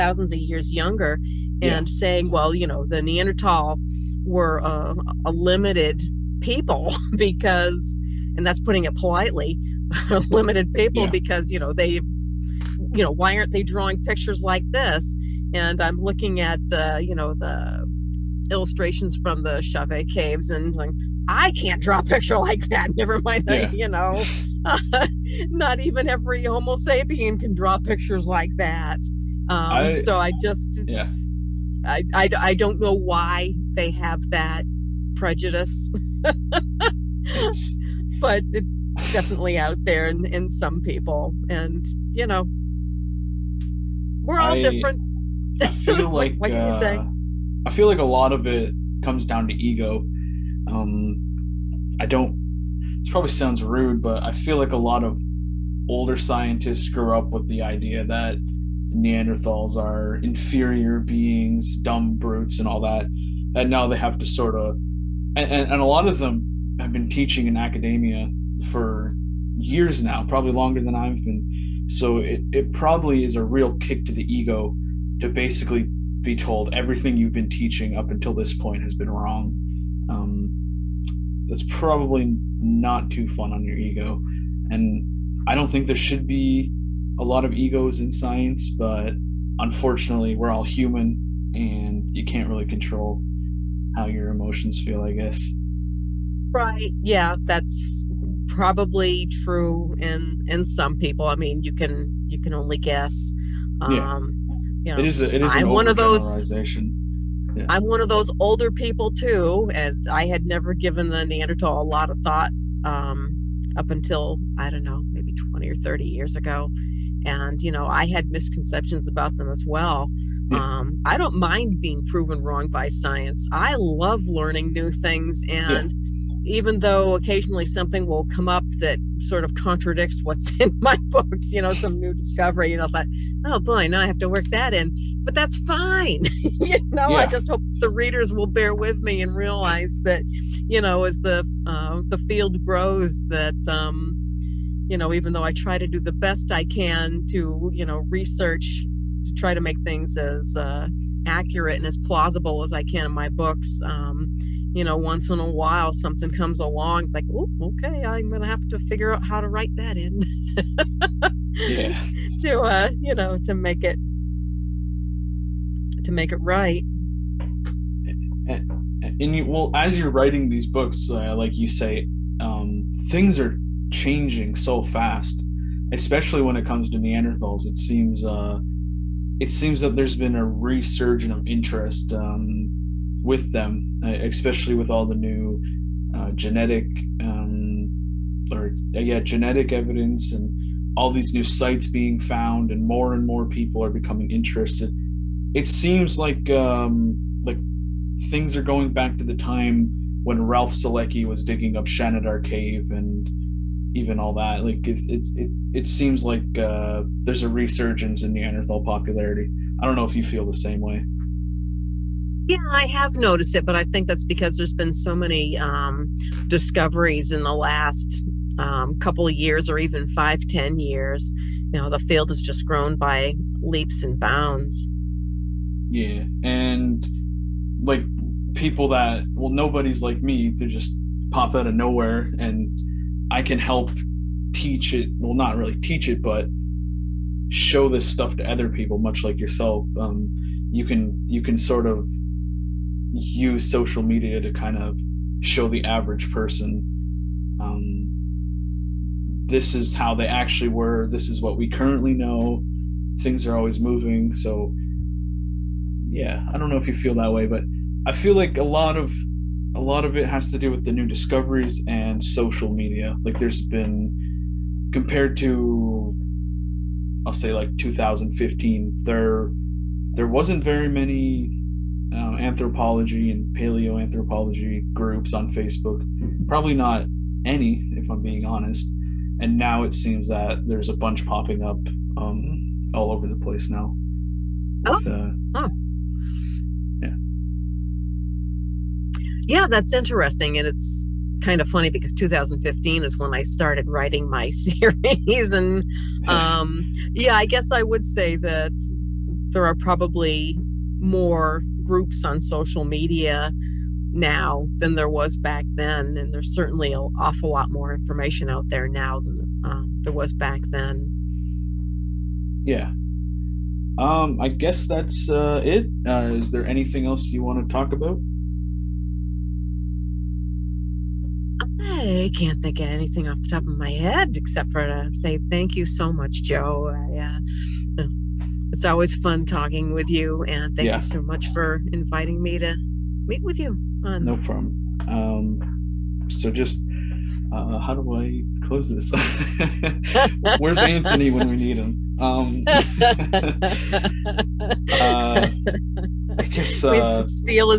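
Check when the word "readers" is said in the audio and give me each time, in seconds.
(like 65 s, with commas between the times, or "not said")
137 s.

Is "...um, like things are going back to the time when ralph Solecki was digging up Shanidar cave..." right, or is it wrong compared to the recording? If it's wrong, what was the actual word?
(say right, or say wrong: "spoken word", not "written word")
right.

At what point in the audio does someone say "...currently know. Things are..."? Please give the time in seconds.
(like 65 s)
251 s.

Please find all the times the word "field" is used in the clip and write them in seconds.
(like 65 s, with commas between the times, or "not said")
142 s, 221 s.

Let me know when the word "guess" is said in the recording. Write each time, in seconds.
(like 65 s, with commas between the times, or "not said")
95 s, 102 s, 297 s, 314 s, 346 s.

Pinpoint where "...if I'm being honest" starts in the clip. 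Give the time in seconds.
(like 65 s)
277 s.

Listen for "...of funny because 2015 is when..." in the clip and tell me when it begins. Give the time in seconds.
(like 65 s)
291 s.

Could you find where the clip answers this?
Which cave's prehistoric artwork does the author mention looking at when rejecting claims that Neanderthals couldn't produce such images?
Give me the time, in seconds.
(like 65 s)
19 s.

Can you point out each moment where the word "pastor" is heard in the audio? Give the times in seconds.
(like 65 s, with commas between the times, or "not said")
not said.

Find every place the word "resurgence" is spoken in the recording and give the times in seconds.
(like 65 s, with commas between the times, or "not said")
180 s, 207 s.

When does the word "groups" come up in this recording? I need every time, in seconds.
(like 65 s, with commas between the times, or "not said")
274 s, 301 s.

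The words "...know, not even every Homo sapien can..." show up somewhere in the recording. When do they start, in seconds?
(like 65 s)
23 s.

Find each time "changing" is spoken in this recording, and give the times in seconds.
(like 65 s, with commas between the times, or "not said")
173 s.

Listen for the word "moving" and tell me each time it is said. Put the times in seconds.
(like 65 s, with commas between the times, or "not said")
253 s.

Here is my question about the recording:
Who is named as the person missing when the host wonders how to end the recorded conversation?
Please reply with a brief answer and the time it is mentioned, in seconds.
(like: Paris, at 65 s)
Anthony, at 340 s.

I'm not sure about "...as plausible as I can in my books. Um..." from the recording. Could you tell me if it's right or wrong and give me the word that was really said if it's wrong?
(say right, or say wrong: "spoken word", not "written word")
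right.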